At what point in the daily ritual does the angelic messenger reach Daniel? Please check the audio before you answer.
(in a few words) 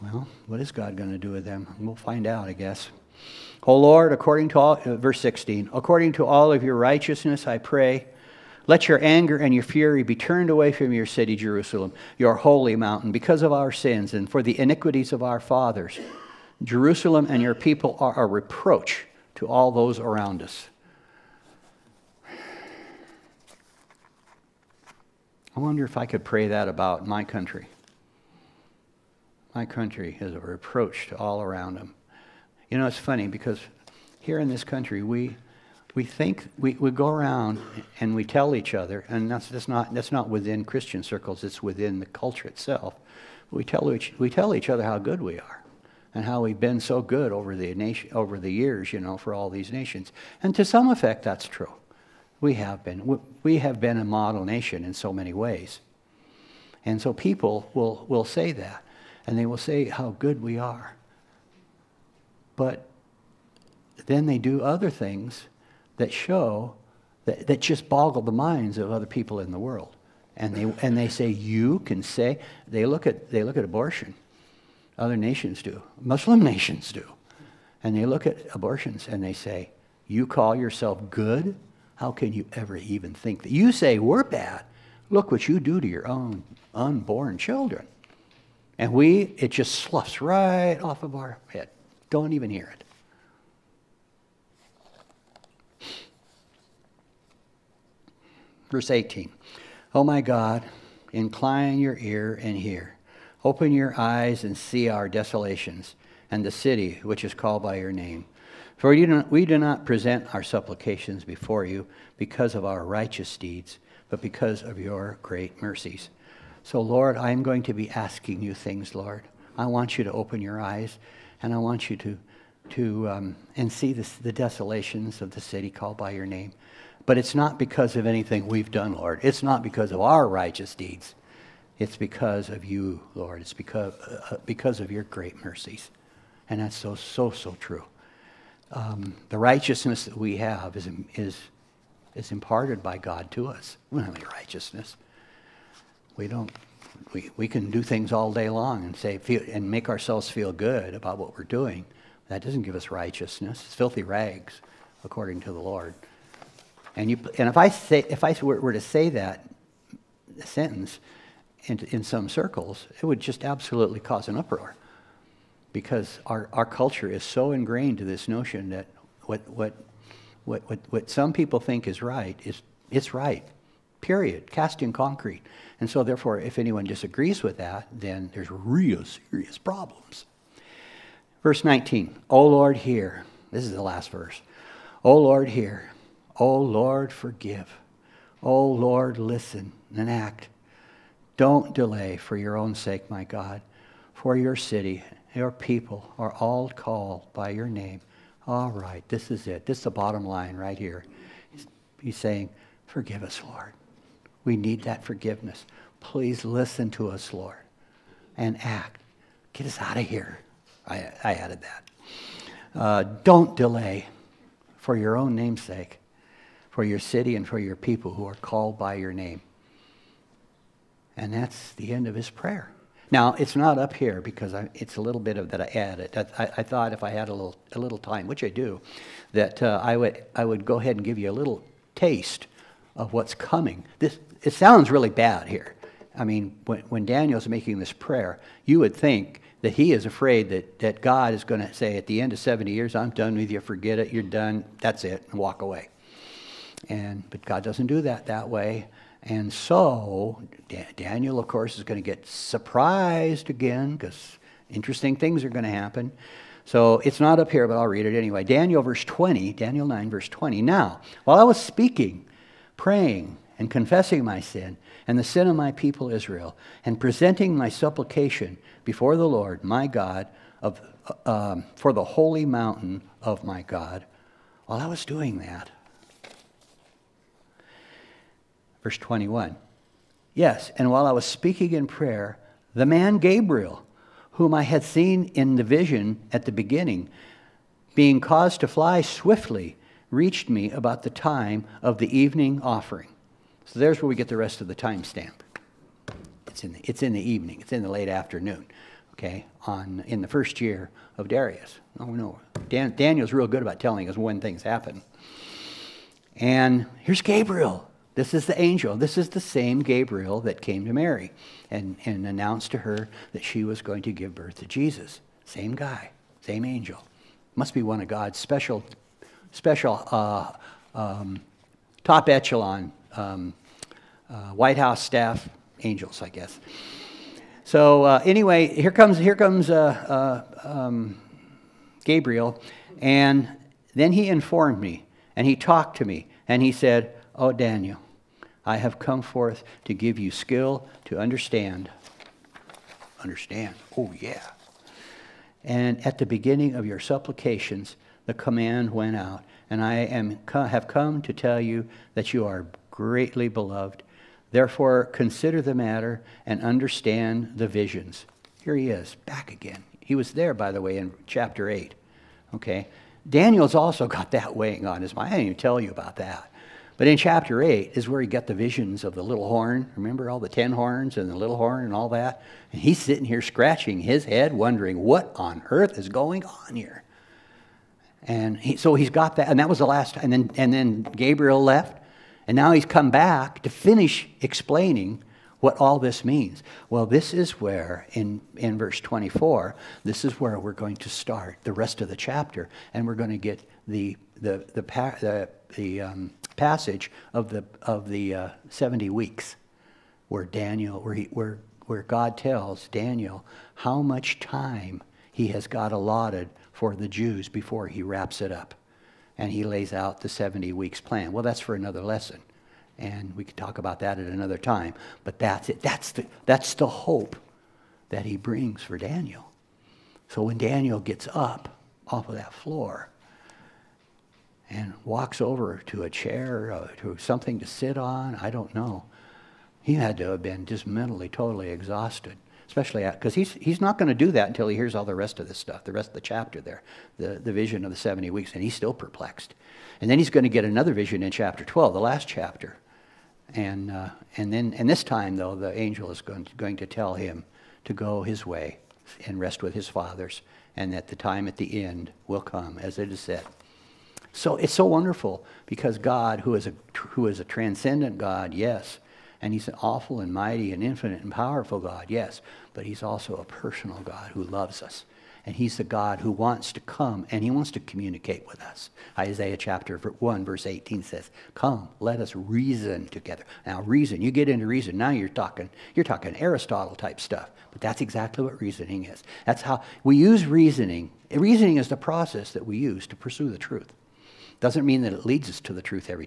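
the evening offering.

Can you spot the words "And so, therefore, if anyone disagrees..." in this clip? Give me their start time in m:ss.
2:55.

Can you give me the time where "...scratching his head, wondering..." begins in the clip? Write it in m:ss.
6:13.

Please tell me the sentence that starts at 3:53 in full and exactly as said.
This, it sounds really bad here.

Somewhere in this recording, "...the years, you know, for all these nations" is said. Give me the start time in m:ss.
0:48.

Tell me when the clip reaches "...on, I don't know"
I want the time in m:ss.
7:07.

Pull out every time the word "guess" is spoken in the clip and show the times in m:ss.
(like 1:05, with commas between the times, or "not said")
0:02, 5:26.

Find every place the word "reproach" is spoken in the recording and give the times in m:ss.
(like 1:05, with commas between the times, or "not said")
0:18, 0:30.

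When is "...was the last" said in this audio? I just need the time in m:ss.
6:19.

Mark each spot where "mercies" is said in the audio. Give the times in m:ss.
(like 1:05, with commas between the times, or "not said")
1:55, 2:15.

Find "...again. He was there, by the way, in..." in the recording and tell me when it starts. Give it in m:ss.
5:59.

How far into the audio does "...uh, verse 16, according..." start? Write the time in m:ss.
0:04.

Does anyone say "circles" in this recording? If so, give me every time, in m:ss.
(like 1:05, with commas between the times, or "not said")
0:41, 2:42.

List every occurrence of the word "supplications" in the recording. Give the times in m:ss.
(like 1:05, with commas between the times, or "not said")
1:50, 4:27, 5:46.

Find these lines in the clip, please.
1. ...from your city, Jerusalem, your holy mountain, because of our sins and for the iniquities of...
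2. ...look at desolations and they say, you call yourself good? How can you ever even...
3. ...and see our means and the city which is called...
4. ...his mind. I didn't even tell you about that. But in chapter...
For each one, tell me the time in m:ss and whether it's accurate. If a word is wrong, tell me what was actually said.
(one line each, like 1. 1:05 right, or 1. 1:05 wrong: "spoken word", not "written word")
1. 0:10 right
2. 1:18 wrong: "abortions", not "desolations"
3. 1:44 wrong: "desolations", not "means"
4. 6:05 right.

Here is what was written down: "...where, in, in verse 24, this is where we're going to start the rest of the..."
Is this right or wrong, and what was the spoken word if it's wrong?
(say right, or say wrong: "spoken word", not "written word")
right.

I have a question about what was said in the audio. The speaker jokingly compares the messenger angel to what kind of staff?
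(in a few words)
White House staff.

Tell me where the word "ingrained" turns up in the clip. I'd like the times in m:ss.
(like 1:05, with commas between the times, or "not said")
2:47.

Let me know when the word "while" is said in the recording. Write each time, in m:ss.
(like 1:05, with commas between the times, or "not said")
4:21, 4:34, 4:40.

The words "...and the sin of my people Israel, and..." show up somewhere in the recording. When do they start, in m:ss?
4:25.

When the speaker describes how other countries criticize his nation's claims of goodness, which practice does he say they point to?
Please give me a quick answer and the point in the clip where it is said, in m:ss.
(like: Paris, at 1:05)
abortion, at 1:13.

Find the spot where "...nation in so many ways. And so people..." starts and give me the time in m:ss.
0:54.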